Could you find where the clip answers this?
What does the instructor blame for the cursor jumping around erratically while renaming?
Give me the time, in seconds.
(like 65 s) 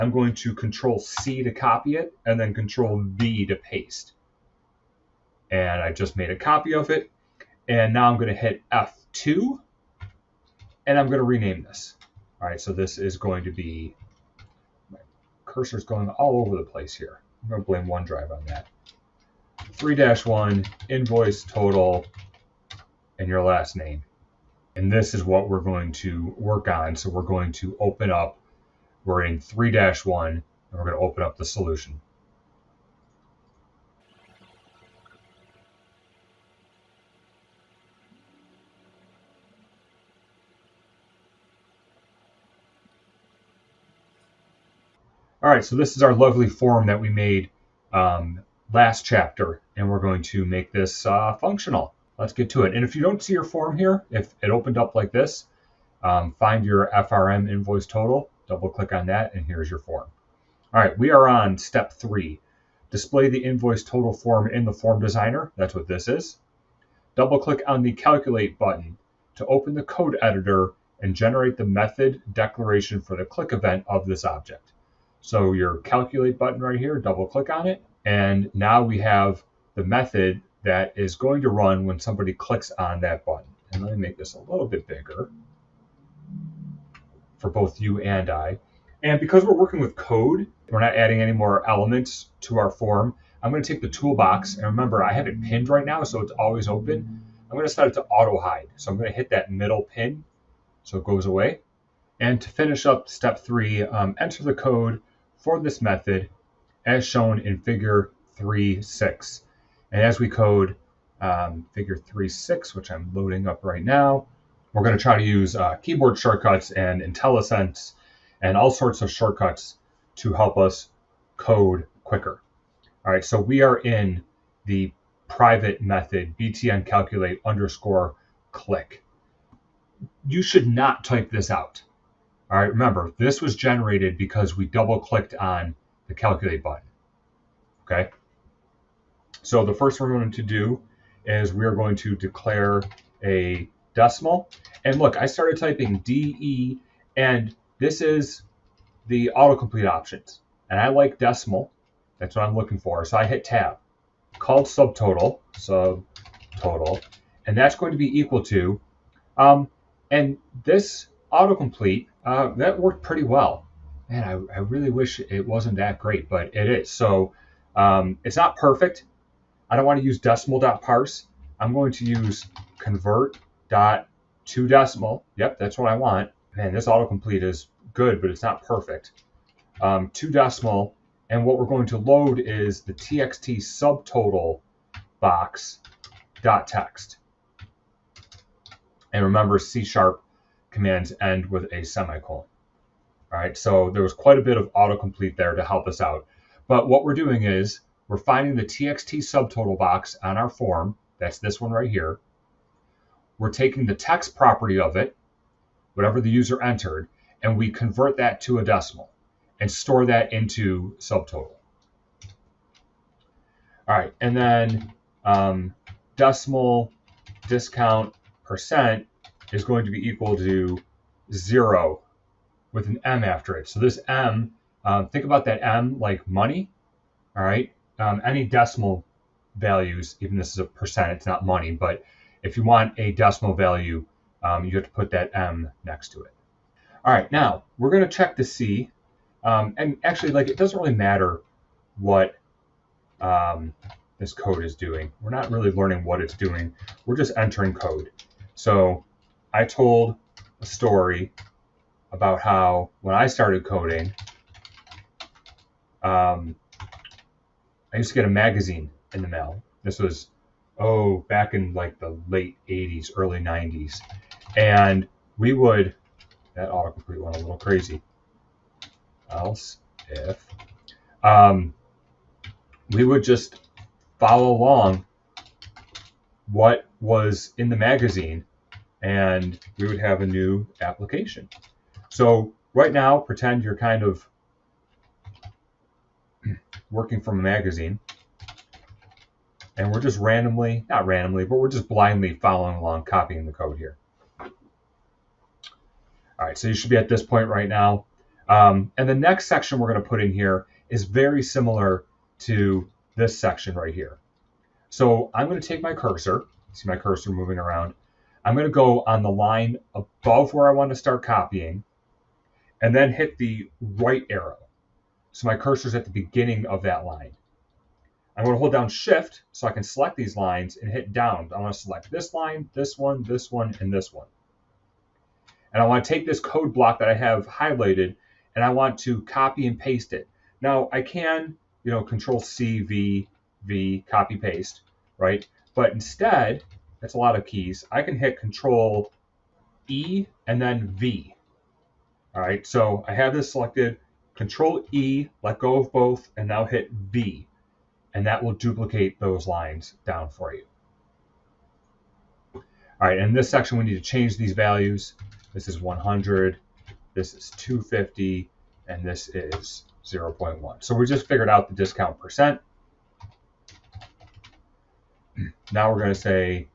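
17 s.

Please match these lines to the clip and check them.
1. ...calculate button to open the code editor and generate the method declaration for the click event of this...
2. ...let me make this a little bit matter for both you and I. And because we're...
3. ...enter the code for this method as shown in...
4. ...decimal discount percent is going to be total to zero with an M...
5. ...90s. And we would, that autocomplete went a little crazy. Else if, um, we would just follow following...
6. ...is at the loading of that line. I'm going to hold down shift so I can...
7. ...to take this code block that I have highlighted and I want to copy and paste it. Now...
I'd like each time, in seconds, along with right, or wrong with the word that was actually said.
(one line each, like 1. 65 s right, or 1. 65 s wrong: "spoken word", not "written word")
1. 67 s right
2. 83 s wrong: "bigger", not "matter"
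3. 104 s right
4. 216 s wrong: "equal", not "total"
5. 263 s wrong: "along", not "following"
6. 315 s wrong: "beginning", not "loading"
7. 326 s right.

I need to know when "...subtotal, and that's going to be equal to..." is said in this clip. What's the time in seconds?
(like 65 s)
155 s.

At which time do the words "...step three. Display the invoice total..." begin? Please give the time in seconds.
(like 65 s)
61 s.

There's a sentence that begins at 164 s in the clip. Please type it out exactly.
Man, I, I really wish it wasn't that great, but it is.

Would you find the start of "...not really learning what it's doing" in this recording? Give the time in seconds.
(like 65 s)
245 s.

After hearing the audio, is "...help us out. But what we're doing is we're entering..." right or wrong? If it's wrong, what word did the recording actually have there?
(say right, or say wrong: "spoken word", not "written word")
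wrong: "finding", not "entering".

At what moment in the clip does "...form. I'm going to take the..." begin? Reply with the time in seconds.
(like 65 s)
92 s.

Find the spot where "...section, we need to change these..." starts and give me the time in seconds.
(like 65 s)
353 s.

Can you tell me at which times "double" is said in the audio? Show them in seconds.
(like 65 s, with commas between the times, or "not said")
58 s, 67 s, 76 s, 134 s.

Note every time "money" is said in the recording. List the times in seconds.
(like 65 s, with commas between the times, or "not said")
226 s, 231 s.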